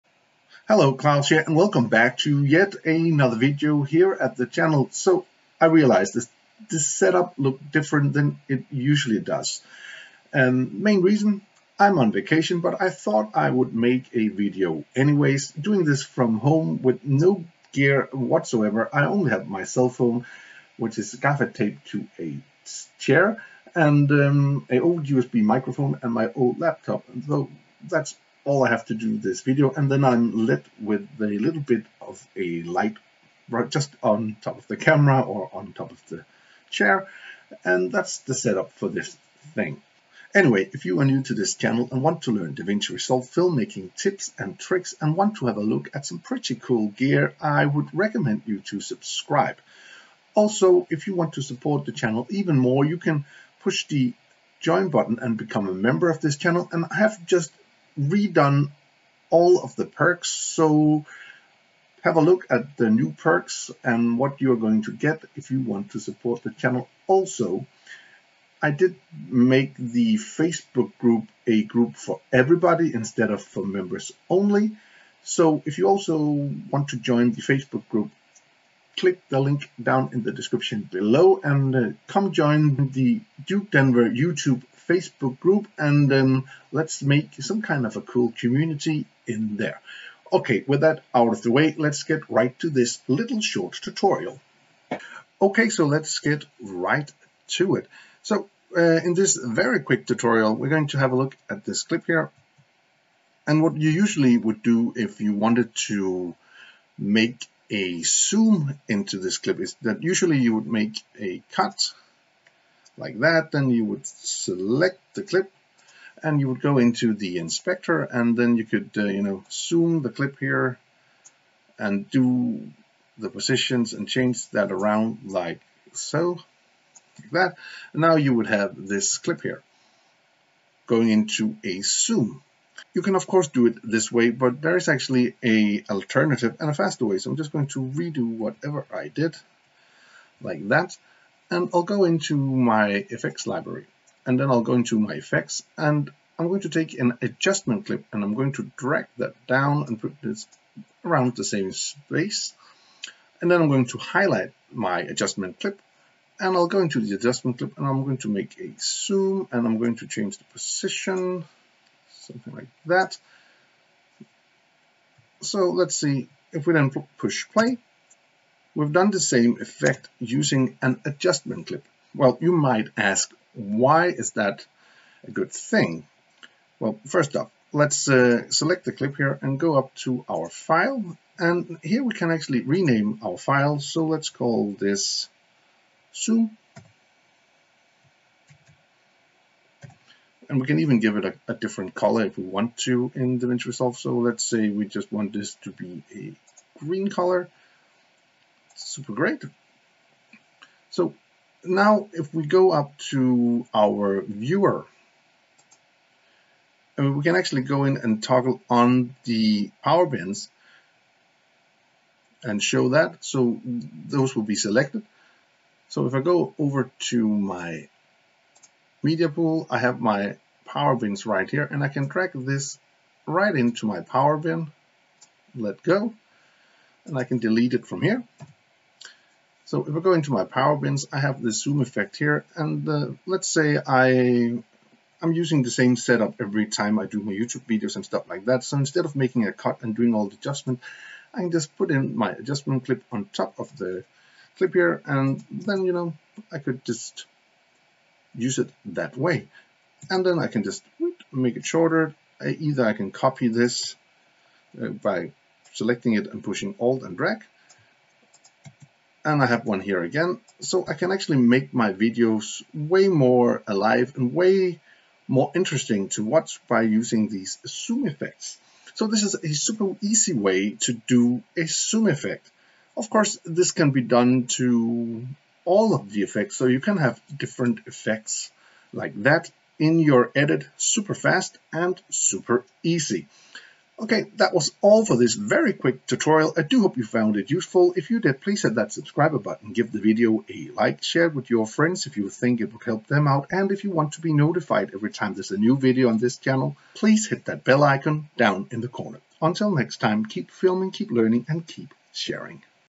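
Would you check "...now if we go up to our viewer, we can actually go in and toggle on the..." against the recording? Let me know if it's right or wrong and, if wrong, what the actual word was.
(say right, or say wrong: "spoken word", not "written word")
right.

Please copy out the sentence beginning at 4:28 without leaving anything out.
So this is a super easy way to do a zoom effect.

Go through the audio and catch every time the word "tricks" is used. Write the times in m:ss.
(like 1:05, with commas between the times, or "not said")
0:44.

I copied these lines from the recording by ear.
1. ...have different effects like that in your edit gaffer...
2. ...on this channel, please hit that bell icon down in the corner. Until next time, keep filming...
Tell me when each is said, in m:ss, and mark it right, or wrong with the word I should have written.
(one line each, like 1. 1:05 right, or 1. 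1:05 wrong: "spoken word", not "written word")
1. 4:36 wrong: "super", not "gaffer"
2. 4:56 right.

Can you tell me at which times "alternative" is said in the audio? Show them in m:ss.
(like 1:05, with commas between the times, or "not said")
2:15.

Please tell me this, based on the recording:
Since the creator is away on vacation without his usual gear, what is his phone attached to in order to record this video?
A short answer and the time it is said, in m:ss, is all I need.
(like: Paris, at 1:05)
A chair, at 0:21.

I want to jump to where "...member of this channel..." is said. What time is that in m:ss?
0:55.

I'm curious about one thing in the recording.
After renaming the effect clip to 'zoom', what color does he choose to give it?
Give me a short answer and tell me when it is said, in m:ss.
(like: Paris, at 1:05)
Green, at 3:16.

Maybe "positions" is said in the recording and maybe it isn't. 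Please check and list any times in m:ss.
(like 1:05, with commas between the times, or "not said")
2:03, 2:40.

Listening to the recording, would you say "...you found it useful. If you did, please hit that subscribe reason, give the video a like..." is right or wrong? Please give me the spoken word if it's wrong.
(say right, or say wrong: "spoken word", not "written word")
wrong: "button", not "reason".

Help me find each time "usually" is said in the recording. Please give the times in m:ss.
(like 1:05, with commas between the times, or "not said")
0:08, 1:43, 1:50.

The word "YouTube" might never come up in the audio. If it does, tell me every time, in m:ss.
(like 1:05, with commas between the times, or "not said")
1:24, 3:57.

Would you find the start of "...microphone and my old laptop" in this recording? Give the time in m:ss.
0:25.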